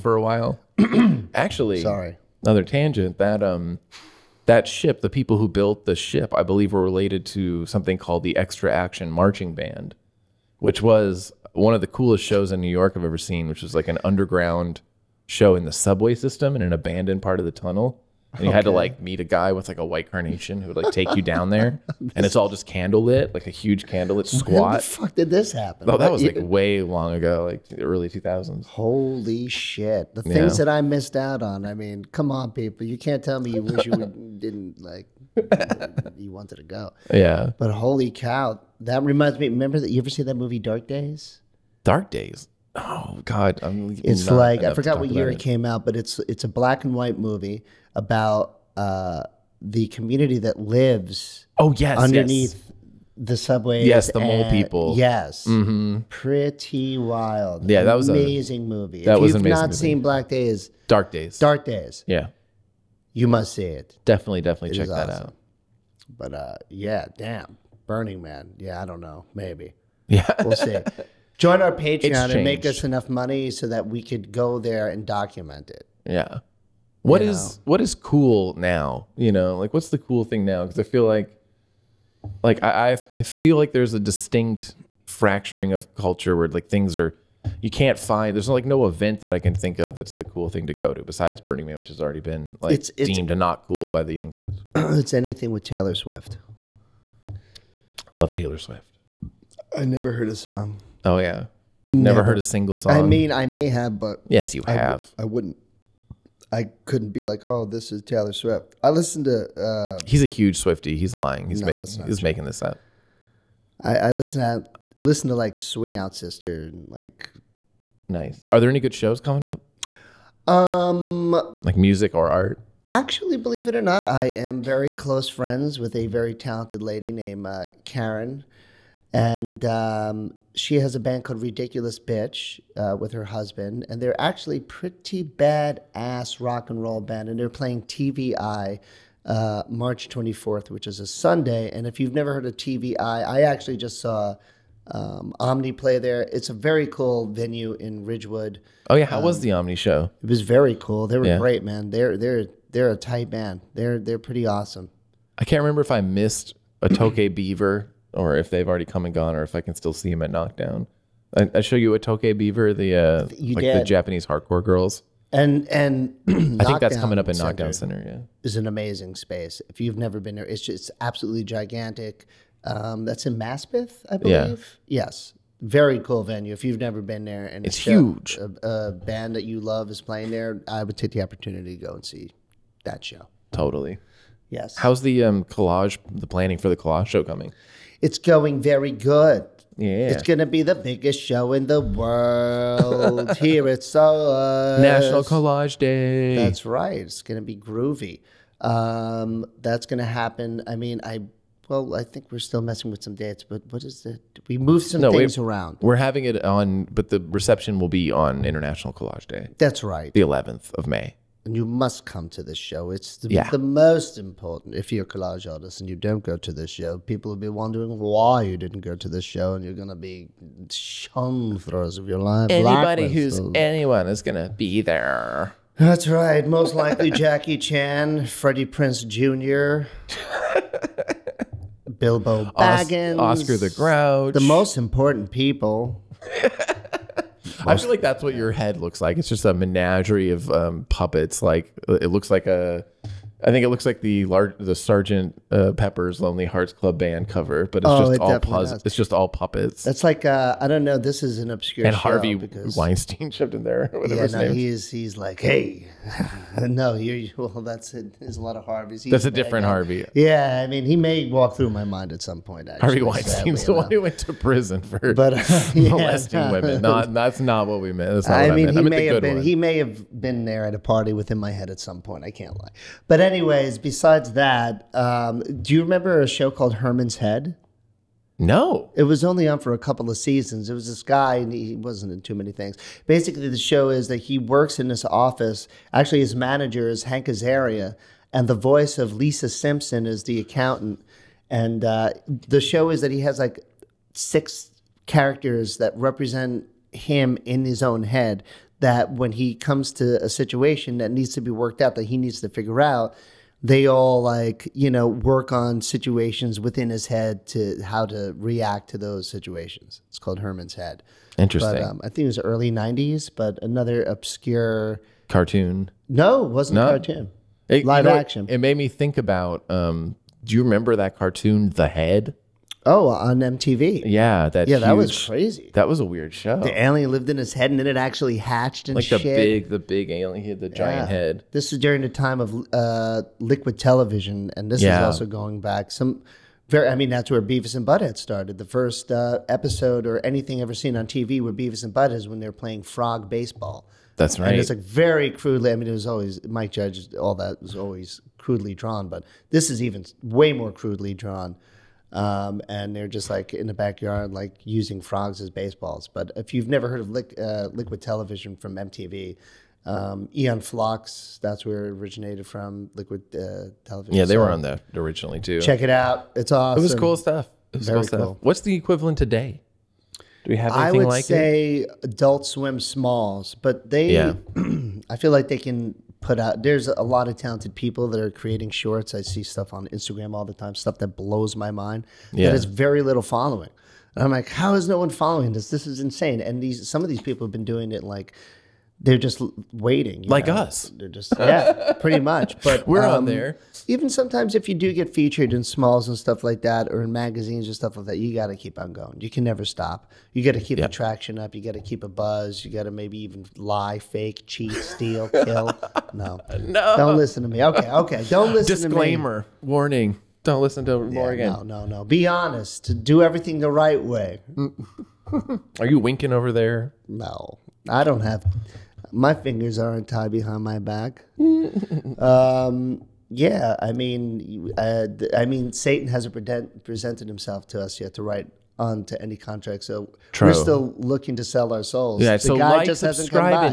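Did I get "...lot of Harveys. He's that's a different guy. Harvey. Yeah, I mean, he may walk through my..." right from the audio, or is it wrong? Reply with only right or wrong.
right.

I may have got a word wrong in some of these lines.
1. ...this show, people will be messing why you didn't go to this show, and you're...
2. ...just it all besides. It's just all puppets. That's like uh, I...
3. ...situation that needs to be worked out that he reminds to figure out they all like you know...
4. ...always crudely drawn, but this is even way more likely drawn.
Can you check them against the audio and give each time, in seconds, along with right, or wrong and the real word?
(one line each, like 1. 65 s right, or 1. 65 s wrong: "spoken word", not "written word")
1. 216 s wrong: "wondering", not "messing"
2. 247 s wrong: "puzzles", not "besides"
3. 300 s wrong: "needs", not "reminds"
4. 347 s wrong: "crudely", not "likely".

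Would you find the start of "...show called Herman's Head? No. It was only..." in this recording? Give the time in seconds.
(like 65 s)
276 s.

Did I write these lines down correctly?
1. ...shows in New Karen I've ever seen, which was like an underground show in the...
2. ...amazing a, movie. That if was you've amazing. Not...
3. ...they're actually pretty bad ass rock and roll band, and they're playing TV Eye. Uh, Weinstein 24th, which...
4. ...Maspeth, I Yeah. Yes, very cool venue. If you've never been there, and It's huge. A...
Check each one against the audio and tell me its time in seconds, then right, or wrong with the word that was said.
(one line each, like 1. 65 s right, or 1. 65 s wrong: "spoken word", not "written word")
1. 12 s wrong: "York", not "Karen"
2. 58 s right
3. 134 s wrong: "March", not "Weinstein"
4. 173 s right.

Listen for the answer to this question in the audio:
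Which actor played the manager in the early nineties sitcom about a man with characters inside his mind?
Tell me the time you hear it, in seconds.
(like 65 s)
287 s.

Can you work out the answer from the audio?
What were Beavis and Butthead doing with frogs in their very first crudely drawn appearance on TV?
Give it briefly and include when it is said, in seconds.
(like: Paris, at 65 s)
Frog baseball, at 342 s.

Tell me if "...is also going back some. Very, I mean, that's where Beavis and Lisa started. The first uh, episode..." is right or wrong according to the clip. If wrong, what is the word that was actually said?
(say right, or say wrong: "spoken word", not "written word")
wrong: "Butthead", not "Lisa".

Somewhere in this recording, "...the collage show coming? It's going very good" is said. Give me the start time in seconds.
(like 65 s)
186 s.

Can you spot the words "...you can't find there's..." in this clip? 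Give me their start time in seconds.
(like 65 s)
87 s.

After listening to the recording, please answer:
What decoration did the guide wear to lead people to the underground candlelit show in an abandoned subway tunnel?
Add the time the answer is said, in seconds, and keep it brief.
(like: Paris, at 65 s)
White carnation, at 19 s.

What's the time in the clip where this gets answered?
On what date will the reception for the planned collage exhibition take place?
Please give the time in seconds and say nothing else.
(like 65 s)
210 s.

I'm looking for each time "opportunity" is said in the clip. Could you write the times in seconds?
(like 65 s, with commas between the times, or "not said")
181 s.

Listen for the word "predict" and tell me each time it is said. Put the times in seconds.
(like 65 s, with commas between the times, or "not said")
not said.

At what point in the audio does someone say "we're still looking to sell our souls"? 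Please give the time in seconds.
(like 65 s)
430 s.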